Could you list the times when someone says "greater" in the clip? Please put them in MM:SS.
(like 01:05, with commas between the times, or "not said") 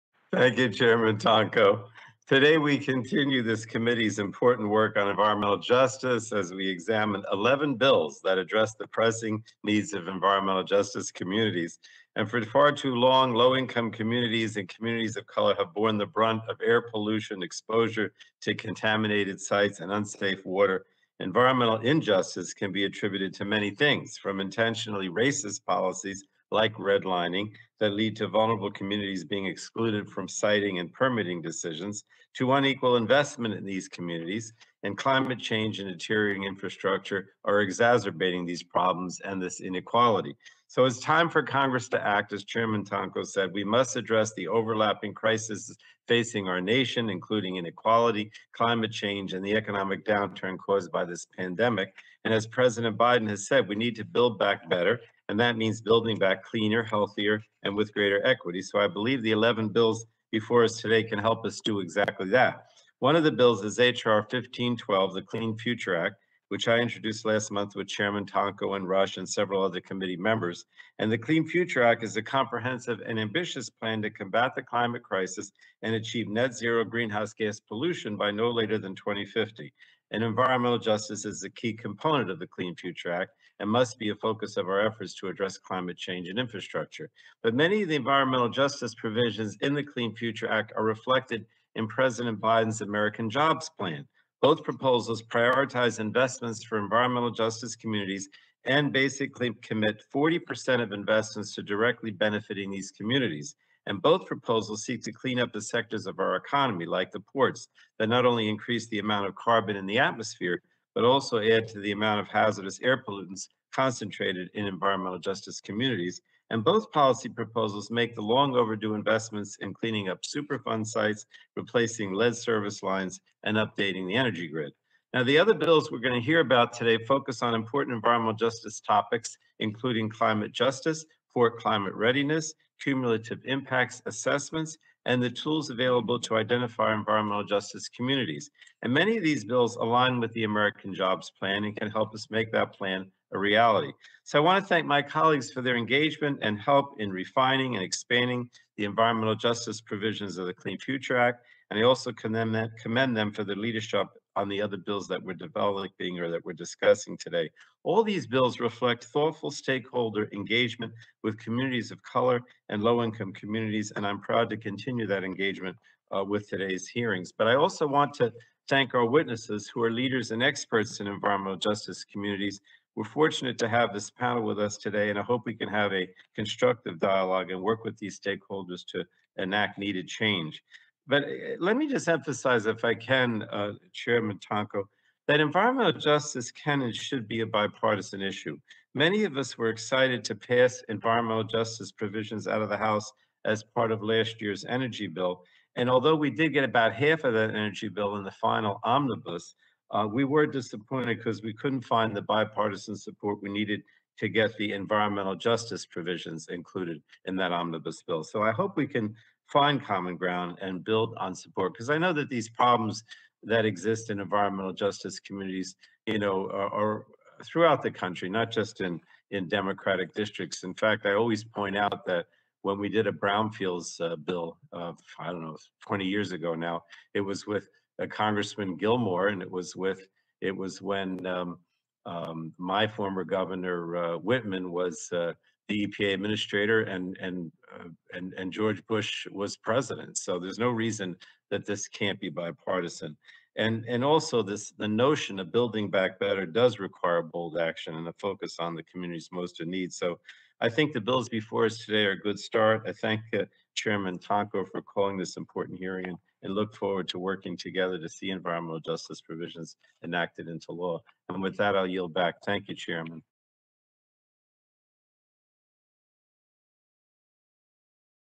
00:57.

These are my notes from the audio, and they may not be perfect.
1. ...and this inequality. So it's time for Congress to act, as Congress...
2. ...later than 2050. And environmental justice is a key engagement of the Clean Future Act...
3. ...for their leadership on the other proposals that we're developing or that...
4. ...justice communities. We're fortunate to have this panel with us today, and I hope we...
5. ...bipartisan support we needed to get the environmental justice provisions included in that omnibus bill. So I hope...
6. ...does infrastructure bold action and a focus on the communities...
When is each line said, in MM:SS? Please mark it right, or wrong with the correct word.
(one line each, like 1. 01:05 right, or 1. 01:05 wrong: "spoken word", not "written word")
1. 00:39 wrong: "Chairman", not "Congress"
2. 01:18 wrong: "component", not "engagement"
3. 02:33 wrong: "bills", not "proposals"
4. 02:51 right
5. 03:22 right
6. 04:06 wrong: "require", not "infrastructure".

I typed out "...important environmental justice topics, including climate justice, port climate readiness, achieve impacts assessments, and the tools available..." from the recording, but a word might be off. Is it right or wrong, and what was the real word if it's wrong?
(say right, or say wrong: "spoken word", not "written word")
wrong: "cumulative", not "achieve".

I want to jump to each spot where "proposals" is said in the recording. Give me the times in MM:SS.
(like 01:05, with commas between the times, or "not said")
01:34, 01:44, 01:57.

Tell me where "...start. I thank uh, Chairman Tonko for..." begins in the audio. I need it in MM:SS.
04:12.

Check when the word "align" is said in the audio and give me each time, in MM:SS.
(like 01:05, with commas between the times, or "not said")
02:19.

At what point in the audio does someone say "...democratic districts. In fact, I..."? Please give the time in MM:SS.
03:39.